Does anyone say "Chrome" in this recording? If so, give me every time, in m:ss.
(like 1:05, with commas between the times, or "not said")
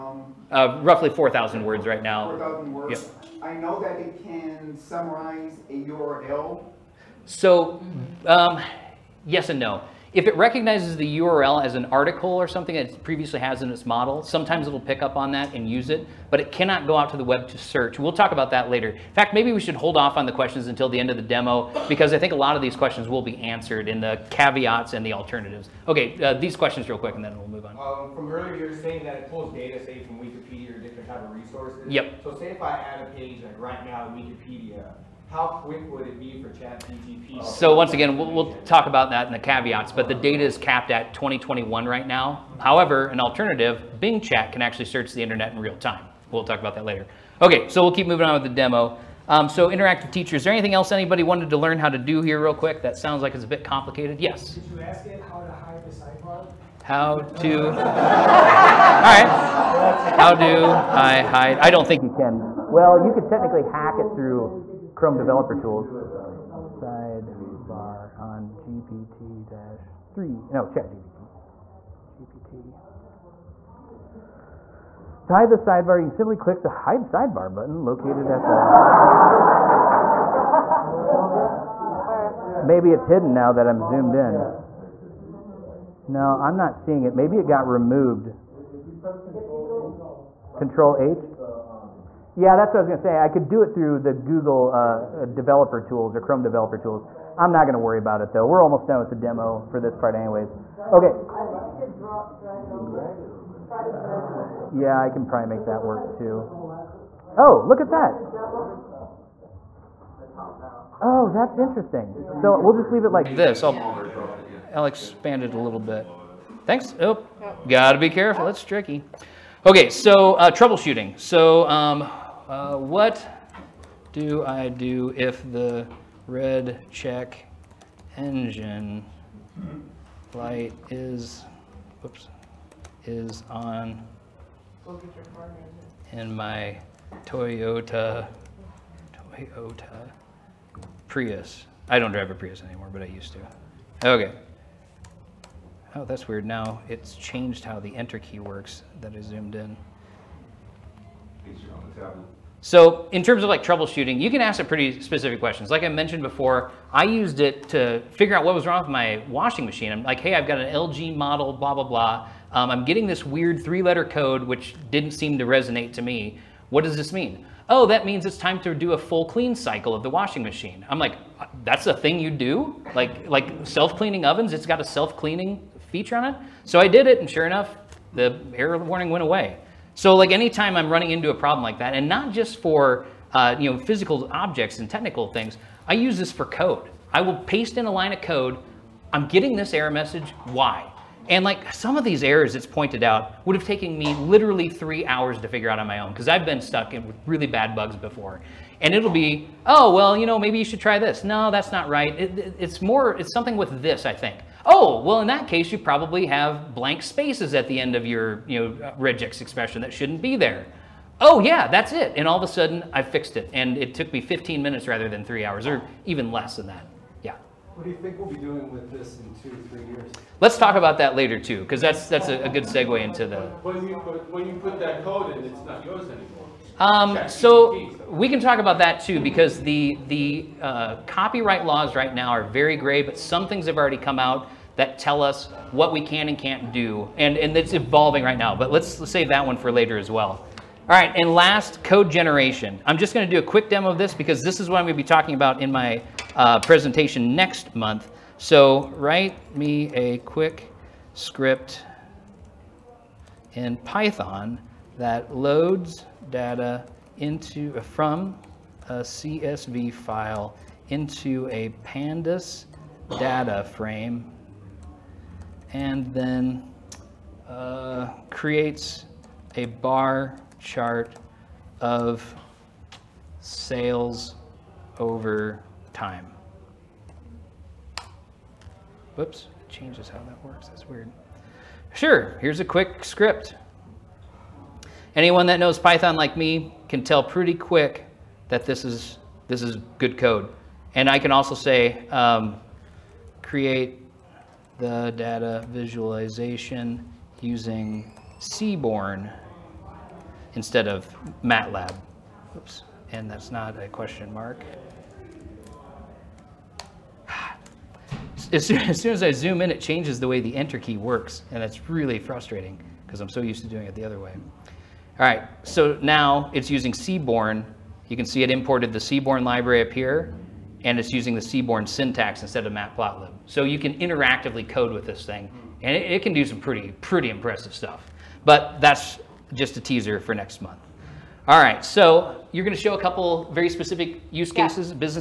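1:04, 1:36.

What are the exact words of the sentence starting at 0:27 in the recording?
Um, from earlier, you were saying that it pulls data, say, from Wikipedia or different type of resources.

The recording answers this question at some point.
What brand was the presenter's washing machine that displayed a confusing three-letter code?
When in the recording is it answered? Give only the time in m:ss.
2:40.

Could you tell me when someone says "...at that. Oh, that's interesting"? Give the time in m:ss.
1:47.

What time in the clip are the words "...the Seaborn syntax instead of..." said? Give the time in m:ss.
5:21.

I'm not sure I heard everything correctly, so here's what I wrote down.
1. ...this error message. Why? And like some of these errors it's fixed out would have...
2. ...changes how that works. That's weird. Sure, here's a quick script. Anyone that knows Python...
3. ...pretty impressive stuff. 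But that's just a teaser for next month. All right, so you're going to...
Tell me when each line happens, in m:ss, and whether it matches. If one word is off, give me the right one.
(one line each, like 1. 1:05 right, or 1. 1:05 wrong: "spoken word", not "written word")
1. 3:09 wrong: "pointed", not "fixed"
2. 4:39 right
3. 5:27 right.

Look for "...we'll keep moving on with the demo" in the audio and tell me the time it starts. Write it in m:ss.
0:47.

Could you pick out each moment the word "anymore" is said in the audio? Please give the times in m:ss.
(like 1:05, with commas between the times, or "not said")
2:22, 3:46.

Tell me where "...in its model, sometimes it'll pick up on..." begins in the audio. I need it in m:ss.
0:13.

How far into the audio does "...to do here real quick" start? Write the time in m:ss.
0:51.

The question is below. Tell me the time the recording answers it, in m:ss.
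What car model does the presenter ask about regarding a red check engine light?
2:19.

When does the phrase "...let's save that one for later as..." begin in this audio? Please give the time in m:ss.
3:58.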